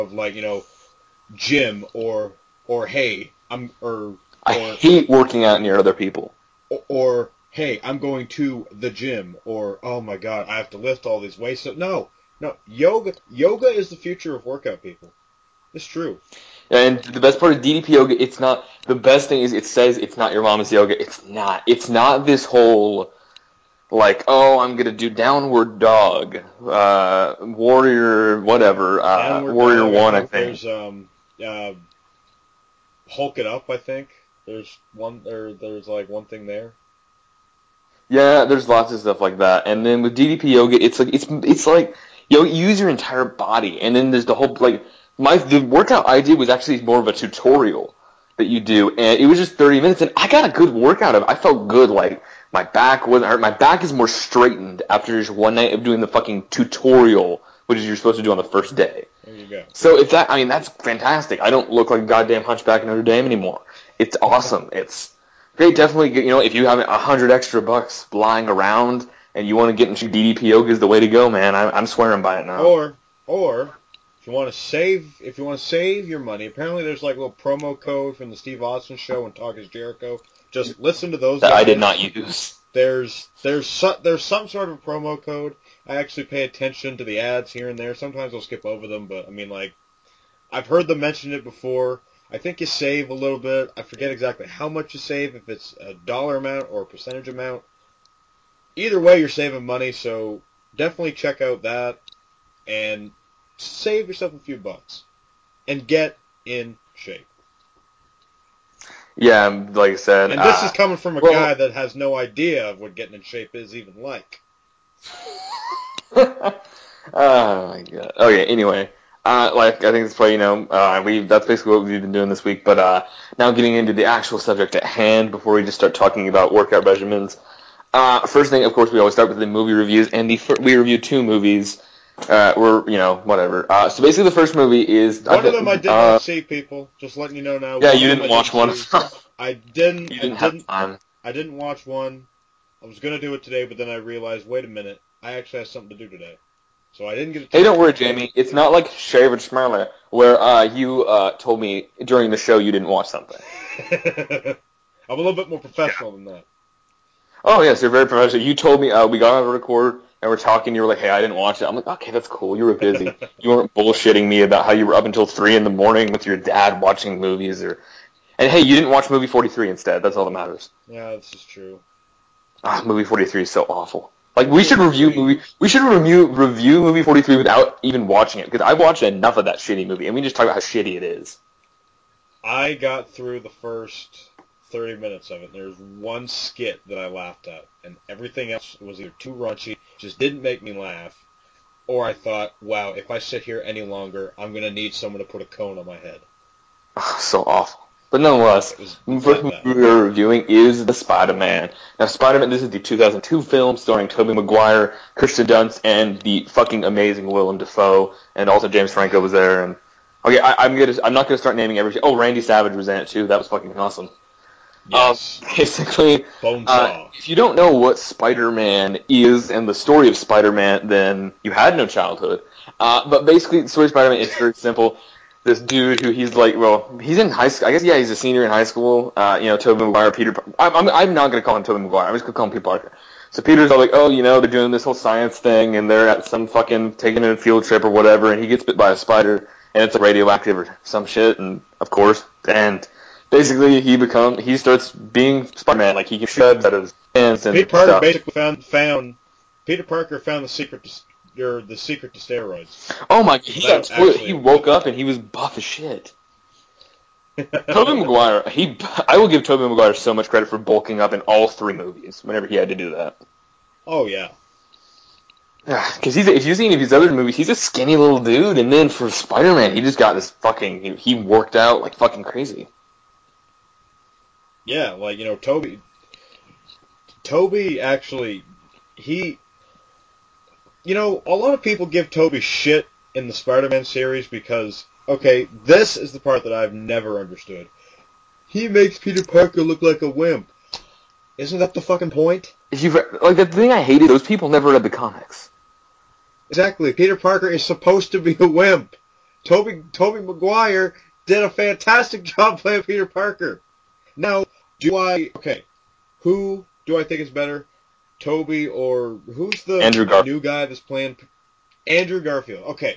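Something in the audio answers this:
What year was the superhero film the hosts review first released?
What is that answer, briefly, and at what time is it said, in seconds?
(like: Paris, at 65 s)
2002, at 202 s.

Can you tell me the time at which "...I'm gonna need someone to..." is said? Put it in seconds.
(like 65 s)
194 s.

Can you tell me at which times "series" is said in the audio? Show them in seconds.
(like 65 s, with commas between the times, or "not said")
283 s.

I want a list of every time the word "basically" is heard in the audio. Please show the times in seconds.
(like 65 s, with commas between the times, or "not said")
121 s, 134 s, 215 s, 223 s, 243 s, 248 s.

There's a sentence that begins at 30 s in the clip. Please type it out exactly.
There's um, uh, Hulk it up I think.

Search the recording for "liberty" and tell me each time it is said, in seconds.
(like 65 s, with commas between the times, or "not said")
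not said.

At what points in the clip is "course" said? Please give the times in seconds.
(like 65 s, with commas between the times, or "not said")
128 s, 241 s.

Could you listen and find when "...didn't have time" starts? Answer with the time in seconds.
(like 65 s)
140 s.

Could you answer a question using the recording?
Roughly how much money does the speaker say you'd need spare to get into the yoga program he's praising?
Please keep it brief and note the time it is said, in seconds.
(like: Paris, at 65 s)
$100, at 66 s.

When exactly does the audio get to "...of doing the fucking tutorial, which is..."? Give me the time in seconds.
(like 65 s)
55 s.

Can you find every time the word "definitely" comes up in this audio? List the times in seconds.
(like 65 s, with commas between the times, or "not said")
65 s, 100 s.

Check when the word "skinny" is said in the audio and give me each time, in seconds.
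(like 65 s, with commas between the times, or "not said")
267 s.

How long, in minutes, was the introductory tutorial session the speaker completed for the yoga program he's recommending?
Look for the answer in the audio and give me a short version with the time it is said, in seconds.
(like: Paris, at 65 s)
30 minutes, at 49 s.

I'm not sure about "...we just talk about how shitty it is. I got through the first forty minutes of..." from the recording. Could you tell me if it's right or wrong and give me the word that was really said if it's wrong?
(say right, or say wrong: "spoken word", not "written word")
wrong: "thirty", not "forty".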